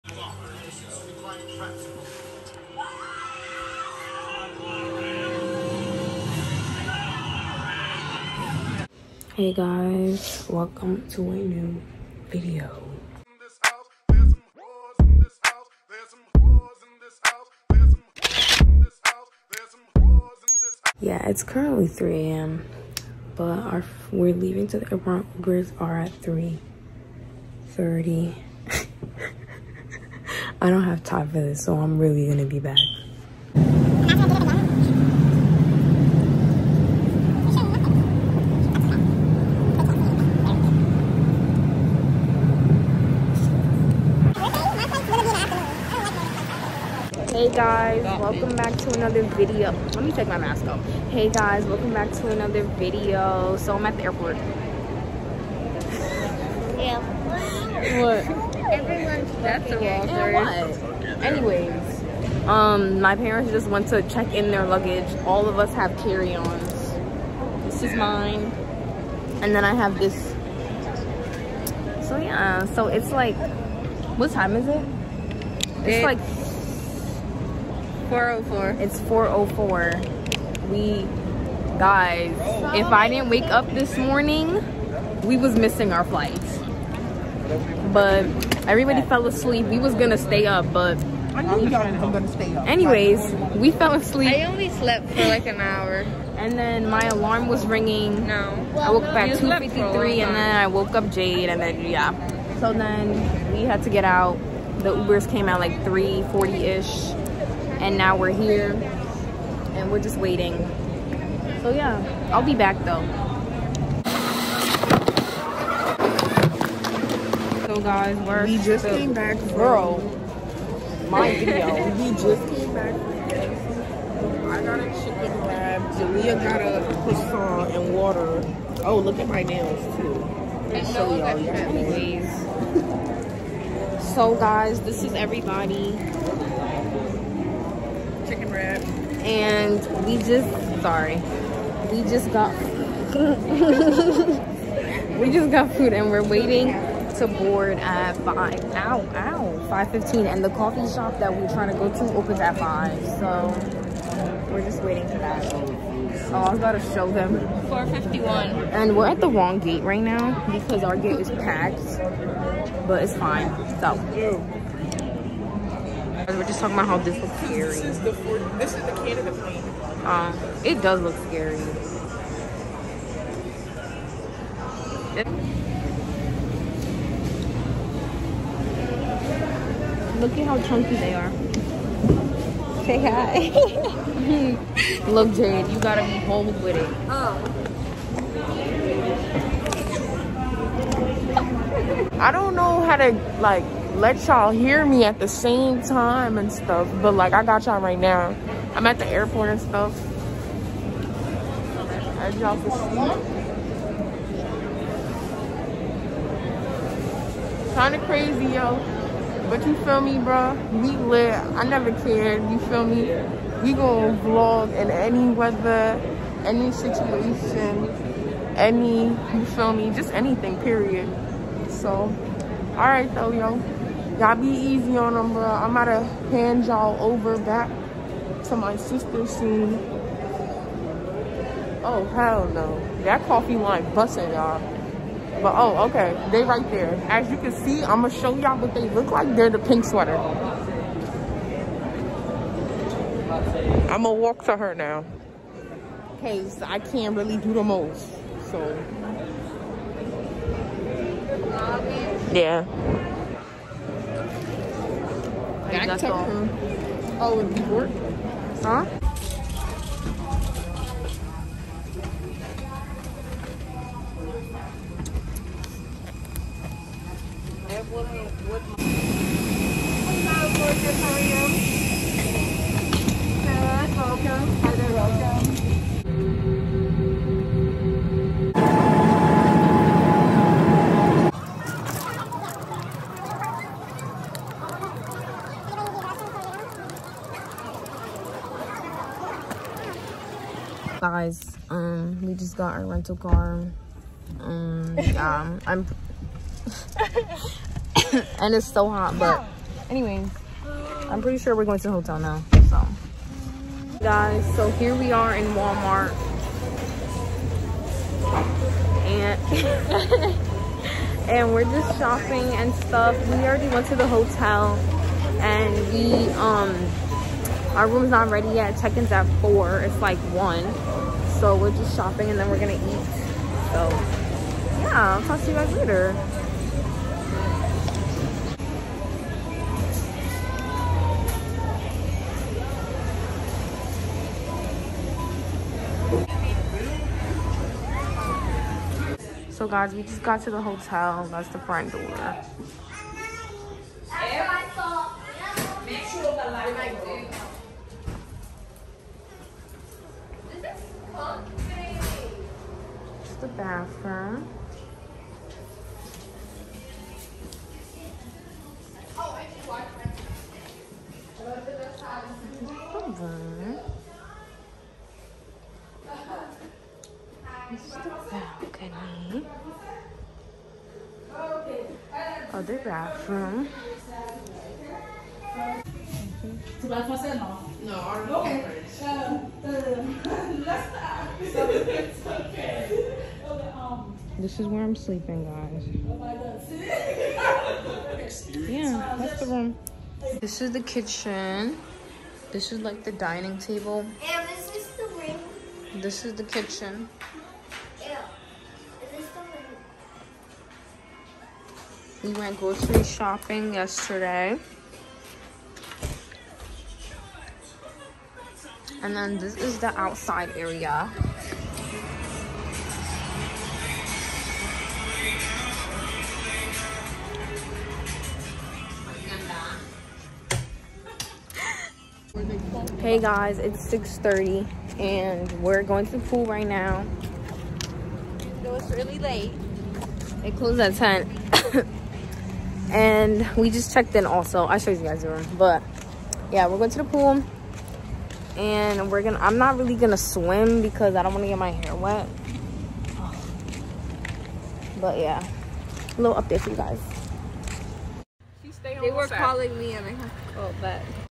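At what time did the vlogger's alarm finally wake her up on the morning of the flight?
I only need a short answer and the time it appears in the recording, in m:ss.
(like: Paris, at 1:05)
2:53, at 1:39.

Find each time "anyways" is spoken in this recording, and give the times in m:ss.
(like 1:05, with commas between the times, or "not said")
1:01, 1:31, 2:11, 4:59.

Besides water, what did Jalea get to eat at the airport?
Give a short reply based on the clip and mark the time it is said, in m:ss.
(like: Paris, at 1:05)
Croissant, at 2:07.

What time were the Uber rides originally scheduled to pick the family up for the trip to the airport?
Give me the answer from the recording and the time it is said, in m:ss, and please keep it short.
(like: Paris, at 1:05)
3:30, at 0:26.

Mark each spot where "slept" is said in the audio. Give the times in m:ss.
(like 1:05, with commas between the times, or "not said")
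1:34.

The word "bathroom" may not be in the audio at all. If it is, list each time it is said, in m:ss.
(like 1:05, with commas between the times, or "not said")
5:53, 6:12.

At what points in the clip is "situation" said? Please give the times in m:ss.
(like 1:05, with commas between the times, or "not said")
3:36.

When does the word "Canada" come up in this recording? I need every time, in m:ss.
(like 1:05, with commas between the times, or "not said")
2:49.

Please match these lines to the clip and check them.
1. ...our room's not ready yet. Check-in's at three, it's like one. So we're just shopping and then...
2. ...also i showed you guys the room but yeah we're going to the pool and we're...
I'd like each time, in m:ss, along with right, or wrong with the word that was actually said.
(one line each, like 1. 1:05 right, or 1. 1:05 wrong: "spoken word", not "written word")
1. 5:17 wrong: "four", not "three"
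2. 7:14 right.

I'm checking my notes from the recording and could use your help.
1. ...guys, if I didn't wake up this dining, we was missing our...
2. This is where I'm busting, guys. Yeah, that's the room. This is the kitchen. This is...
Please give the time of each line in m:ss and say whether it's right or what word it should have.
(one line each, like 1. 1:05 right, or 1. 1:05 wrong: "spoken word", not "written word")
1. 1:21 wrong: "morning", not "dining"
2. 6:24 wrong: "sleeping", not "busting".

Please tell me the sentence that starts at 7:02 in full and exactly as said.
Hey guys, it's 6.30 and we're going to the pool right now.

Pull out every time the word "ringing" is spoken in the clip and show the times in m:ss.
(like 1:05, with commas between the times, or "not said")
1:37.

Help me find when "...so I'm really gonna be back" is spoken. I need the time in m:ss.
0:31.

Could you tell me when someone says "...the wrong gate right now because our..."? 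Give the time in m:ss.
2:39.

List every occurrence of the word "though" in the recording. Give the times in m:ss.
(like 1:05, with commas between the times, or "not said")
1:52, 3:43.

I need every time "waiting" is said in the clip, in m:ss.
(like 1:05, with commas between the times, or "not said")
1:50, 2:26, 2:34.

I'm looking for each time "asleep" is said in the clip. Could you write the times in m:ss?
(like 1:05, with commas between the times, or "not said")
1:29, 1:33.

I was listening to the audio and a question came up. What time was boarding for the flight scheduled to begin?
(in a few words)
5:15.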